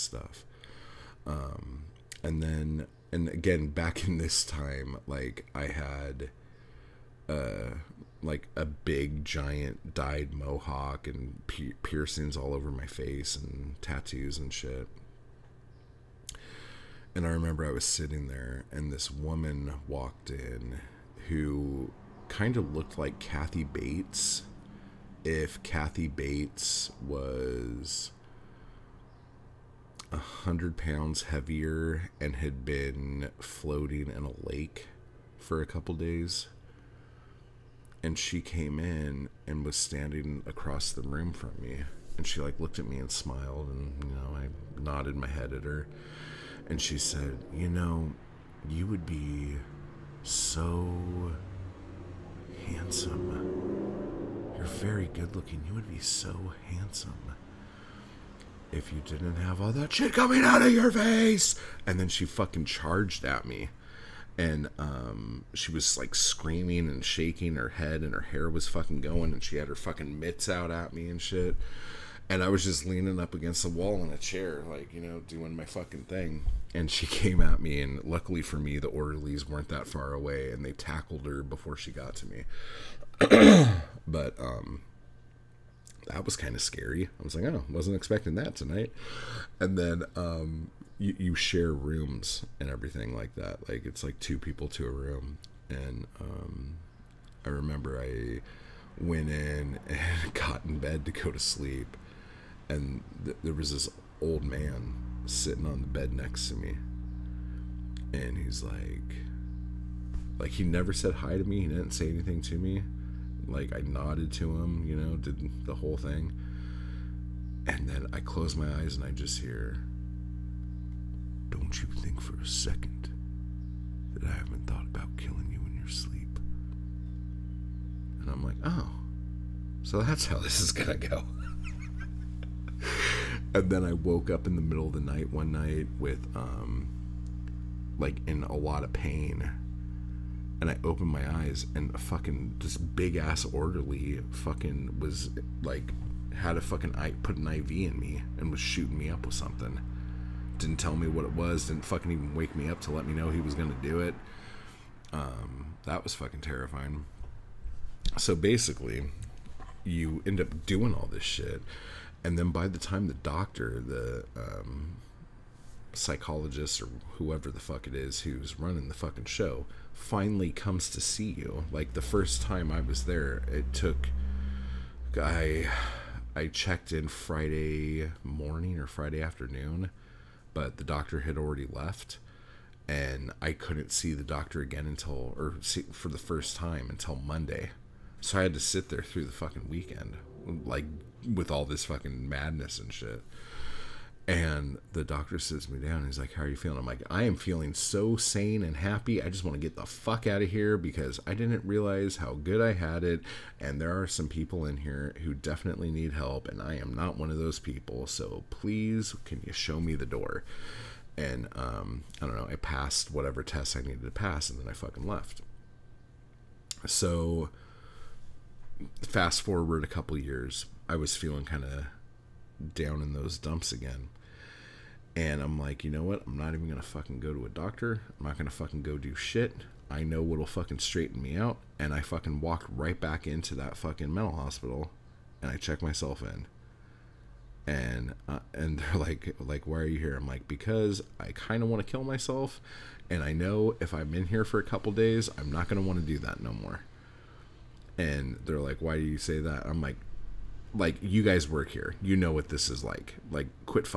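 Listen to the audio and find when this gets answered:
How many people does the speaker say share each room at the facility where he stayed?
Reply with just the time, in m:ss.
1:34.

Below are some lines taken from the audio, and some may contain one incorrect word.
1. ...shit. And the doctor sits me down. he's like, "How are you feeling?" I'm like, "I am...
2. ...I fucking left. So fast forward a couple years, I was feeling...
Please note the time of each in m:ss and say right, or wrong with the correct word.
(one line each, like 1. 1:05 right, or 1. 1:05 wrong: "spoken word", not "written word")
1. 3:12 right
2. 3:34 right.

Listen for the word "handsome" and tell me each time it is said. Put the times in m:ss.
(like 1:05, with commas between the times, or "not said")
0:52, 0:56.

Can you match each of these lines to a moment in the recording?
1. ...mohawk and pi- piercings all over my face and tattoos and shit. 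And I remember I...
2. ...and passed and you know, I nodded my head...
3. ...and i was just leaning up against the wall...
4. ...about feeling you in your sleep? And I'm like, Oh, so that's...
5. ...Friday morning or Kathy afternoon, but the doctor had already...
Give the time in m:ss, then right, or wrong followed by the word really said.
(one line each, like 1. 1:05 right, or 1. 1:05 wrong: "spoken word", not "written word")
1. 0:10 right
2. 0:42 wrong: "smiled", not "passed"
3. 1:12 right
4. 2:04 wrong: "killing", not "feeling"
5. 2:57 wrong: "Friday", not "Kathy".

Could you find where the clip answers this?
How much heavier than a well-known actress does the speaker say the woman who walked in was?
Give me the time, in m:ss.
0:30.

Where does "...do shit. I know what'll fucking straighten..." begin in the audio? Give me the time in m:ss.
3:48.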